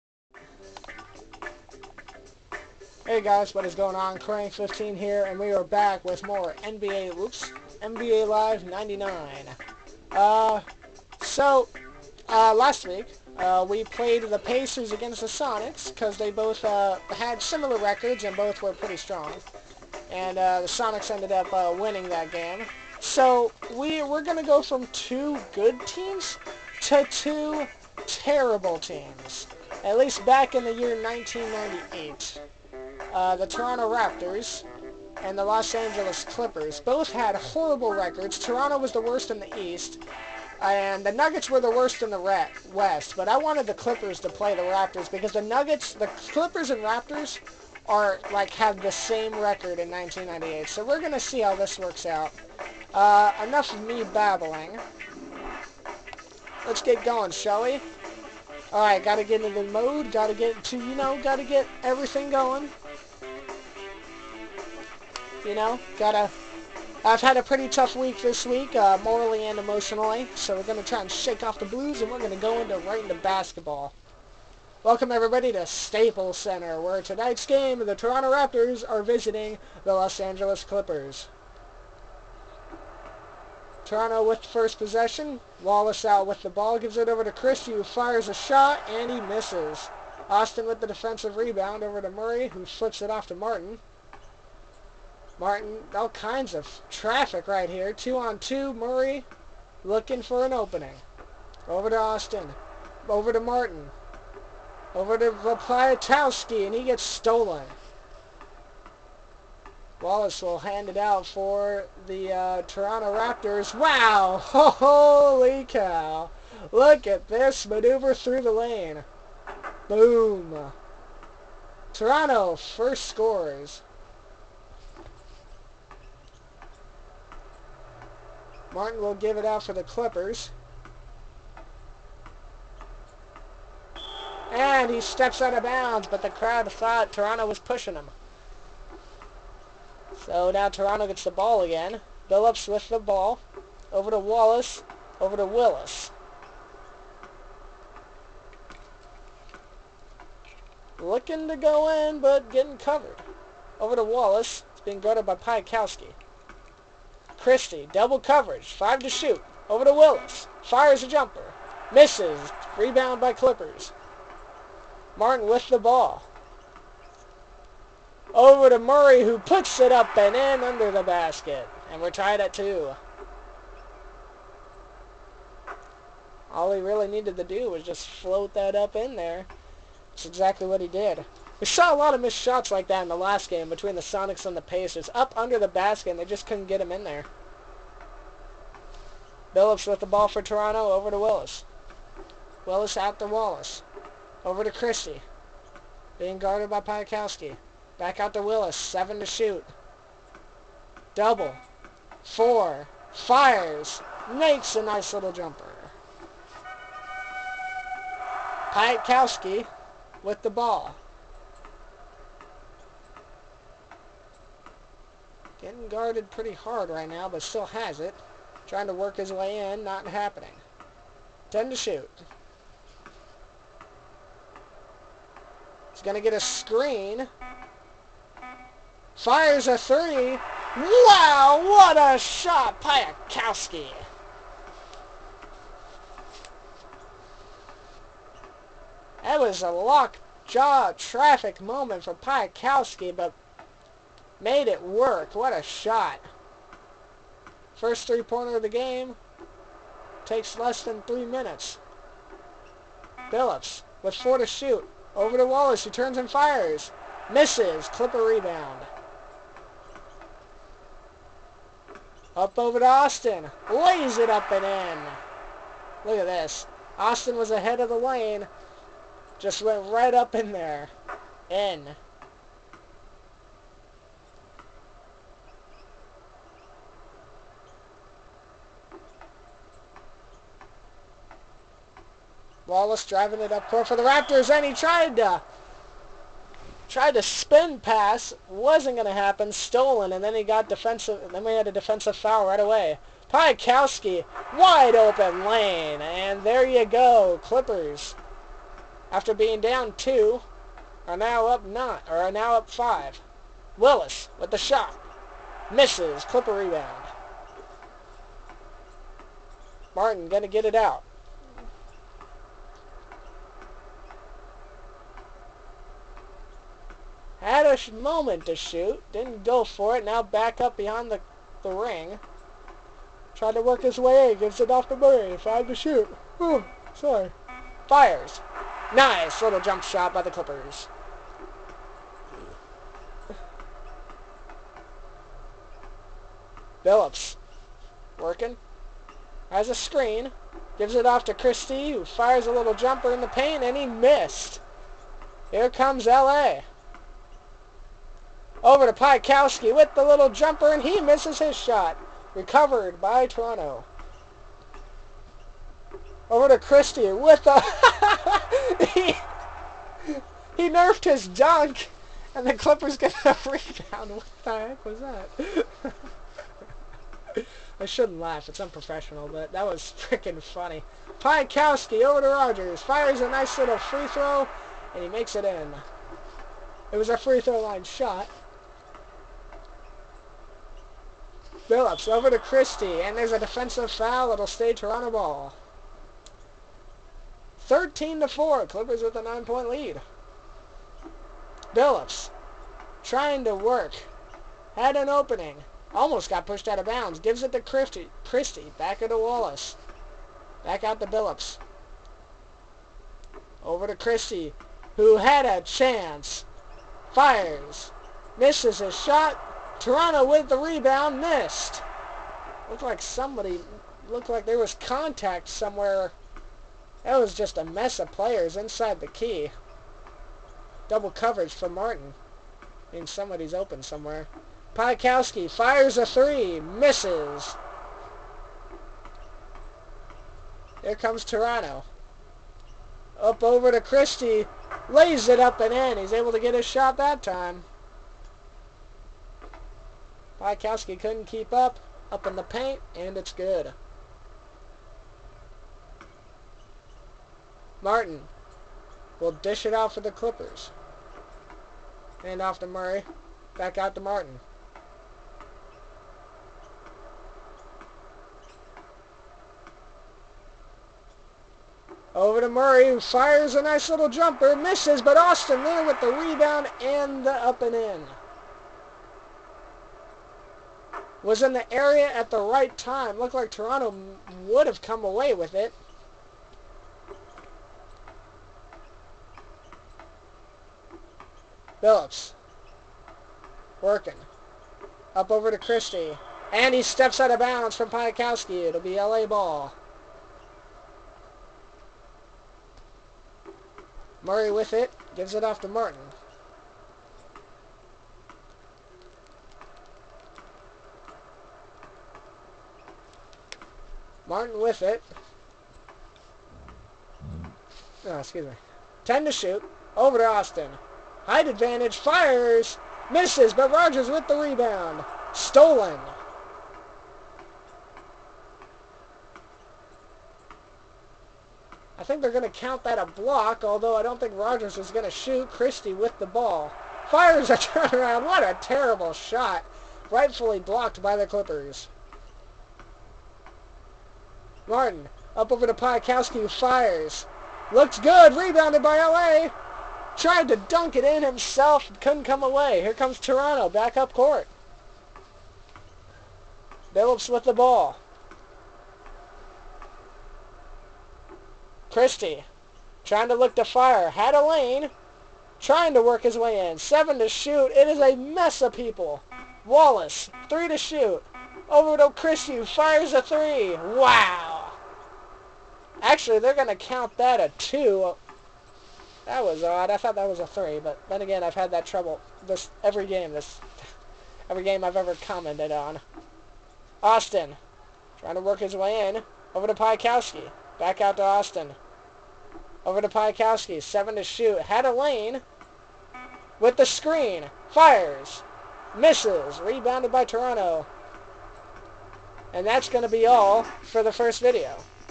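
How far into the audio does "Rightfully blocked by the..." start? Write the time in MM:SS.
08:50.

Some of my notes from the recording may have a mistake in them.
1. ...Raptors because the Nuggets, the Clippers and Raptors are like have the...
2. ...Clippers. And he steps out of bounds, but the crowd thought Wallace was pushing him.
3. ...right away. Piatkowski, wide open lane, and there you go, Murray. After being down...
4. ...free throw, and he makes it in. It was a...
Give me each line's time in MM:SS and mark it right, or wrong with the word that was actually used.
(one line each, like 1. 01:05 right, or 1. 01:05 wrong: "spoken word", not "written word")
1. 00:44 right
2. 02:09 wrong: "Toronto", not "Wallace"
3. 04:52 wrong: "Clippers", not "Murray"
4. 06:13 right.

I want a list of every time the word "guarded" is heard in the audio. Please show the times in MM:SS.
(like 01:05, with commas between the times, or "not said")
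02:34, 03:16, 03:35.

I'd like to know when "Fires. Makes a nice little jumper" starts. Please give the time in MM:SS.
03:23.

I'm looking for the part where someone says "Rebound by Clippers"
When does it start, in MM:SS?
02:42.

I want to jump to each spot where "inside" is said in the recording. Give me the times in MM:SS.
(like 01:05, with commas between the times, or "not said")
06:58.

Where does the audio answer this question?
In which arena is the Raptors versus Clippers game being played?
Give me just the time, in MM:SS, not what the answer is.
01:15.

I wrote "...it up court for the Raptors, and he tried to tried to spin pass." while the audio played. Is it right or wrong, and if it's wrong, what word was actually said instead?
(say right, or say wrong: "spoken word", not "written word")
right.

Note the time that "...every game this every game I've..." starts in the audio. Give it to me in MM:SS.
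09:32.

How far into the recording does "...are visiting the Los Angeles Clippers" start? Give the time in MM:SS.
01:18.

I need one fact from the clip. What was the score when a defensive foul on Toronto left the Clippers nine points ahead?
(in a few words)
13 to 4.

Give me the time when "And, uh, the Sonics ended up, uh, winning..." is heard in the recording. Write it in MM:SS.
00:20.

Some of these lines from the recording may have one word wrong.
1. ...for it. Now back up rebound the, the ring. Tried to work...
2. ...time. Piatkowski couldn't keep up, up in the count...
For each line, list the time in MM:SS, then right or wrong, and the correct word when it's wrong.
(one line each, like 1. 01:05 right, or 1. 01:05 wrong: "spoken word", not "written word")
1. 05:19 wrong: "behind", not "rebound"
2. 07:17 wrong: "paint", not "count".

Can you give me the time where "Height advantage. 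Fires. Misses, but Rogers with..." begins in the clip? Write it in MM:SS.
08:31.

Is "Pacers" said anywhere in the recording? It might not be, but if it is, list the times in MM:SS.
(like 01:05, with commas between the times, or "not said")
00:14, 03:04.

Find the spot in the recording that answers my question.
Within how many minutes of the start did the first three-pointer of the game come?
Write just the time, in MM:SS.
04:10.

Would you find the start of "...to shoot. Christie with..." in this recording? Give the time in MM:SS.
08:45.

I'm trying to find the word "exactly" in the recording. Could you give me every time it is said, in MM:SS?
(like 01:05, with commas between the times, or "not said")
03:00.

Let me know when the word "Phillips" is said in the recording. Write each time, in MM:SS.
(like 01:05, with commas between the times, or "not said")
02:22, 04:13, 05:36, 06:21, 06:31, 06:41, 08:01.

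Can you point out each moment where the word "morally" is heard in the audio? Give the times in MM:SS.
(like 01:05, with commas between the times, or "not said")
01:09.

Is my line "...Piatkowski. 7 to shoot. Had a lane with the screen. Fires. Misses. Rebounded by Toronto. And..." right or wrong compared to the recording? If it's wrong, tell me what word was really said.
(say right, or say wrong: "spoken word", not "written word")
right.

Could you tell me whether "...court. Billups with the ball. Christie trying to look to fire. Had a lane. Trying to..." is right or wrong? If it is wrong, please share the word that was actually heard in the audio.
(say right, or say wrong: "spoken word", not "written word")
right.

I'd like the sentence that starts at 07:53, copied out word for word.
Looked like Toronto would have come away with it.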